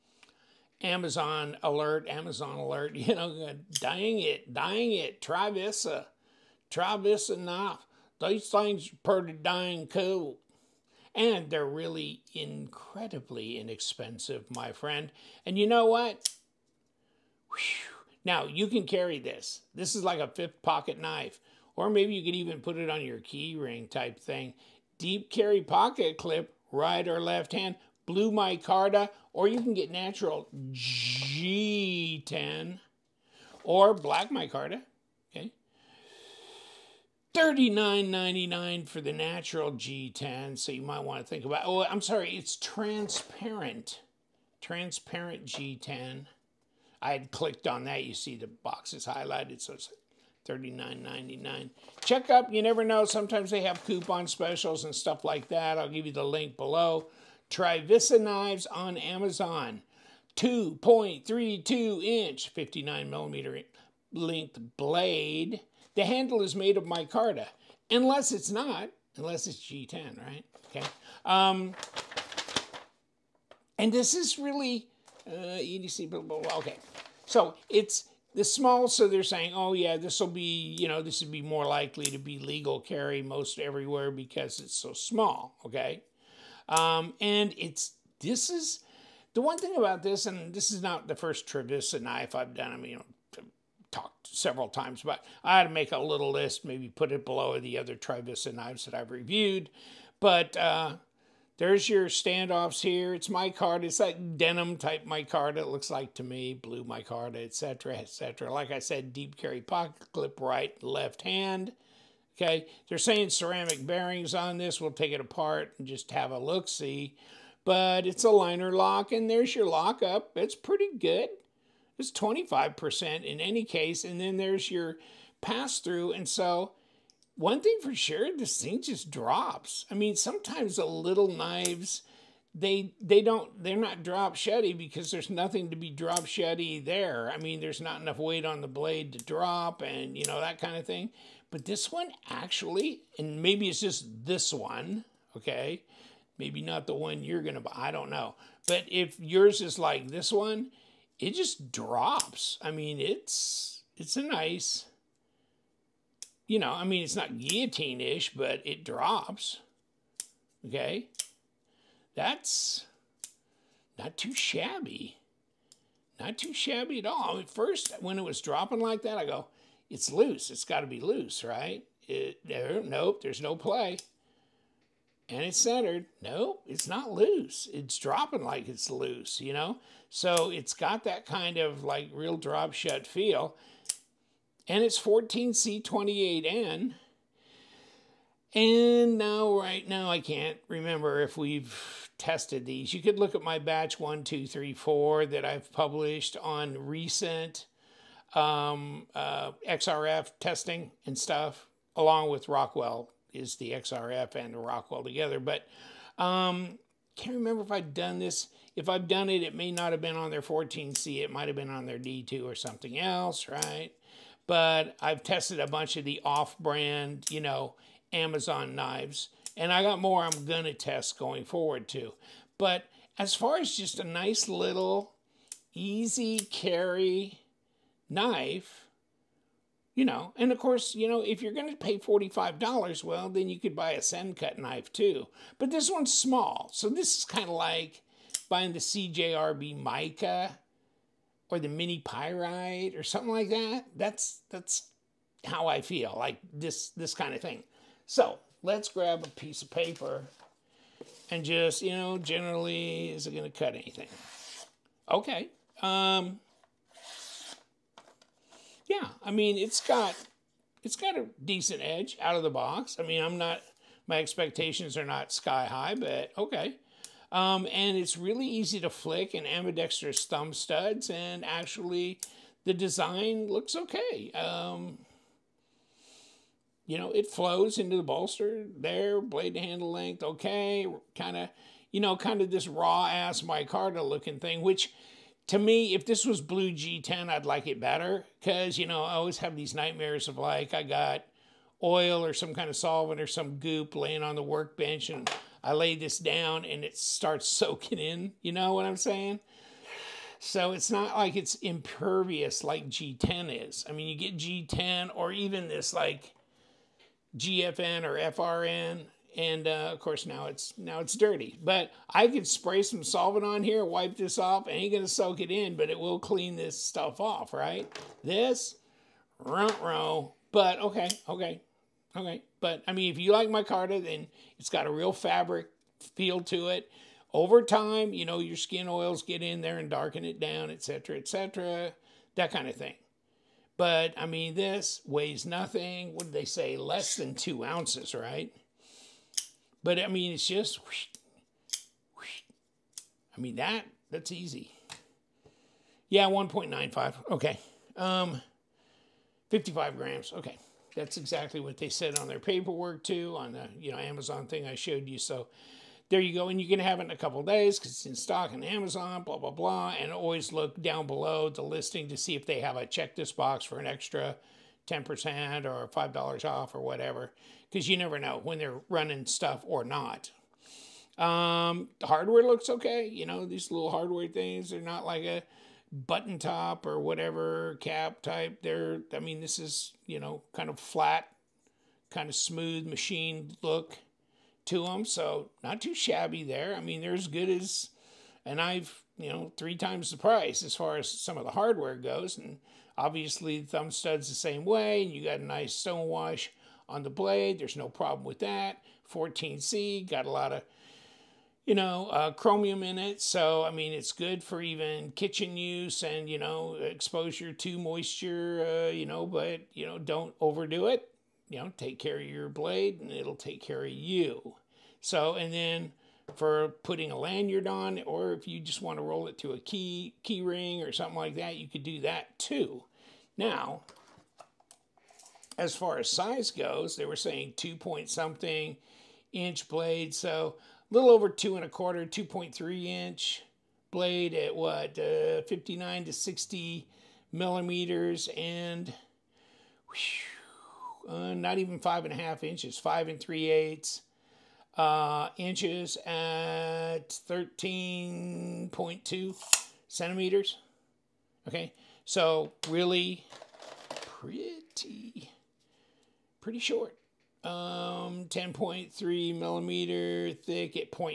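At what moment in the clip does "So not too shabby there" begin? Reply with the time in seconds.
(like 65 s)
385 s.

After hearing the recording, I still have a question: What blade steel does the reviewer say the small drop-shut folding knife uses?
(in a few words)
14C28N.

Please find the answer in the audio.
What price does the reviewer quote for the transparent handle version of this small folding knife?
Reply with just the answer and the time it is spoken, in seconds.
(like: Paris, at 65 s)
$39.99, at 37 s.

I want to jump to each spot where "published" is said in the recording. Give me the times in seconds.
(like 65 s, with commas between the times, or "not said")
195 s.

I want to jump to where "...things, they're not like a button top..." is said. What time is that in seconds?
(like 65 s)
374 s.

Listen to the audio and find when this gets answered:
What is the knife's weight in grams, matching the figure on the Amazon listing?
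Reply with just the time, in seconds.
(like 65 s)
349 s.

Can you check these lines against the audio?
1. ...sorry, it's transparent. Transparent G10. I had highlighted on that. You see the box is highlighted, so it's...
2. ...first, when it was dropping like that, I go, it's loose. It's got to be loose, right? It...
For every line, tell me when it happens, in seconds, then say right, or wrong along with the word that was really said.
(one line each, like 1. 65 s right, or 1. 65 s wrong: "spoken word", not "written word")
1. 42 s wrong: "clicked", not "highlighted"
2. 167 s right.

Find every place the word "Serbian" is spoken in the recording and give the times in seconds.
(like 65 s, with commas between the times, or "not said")
not said.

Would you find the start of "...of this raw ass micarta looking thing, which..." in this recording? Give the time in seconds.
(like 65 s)
282 s.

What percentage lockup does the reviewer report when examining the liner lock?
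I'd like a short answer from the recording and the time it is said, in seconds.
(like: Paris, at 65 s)
25%, at 122 s.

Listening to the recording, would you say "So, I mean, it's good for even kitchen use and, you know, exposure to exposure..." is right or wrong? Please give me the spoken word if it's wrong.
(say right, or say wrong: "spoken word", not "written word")
wrong: "moisture", not "exposure".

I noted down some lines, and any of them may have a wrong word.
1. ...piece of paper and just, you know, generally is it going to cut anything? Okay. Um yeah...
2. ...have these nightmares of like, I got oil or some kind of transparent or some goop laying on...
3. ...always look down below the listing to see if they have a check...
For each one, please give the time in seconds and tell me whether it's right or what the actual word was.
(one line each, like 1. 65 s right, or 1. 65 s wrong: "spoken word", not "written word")
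1. 249 s right
2. 289 s wrong: "solvent", not "transparent"
3. 360 s right.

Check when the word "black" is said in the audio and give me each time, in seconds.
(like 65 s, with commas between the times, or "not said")
33 s.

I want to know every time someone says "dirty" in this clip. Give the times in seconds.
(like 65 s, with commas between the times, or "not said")
311 s.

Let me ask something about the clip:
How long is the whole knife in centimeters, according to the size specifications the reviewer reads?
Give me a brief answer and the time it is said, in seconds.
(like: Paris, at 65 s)
13.2 centimeters, at 447 s.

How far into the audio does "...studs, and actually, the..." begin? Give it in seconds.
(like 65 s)
270 s.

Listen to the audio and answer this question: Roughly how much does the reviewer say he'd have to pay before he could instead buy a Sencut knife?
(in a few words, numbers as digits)
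$45.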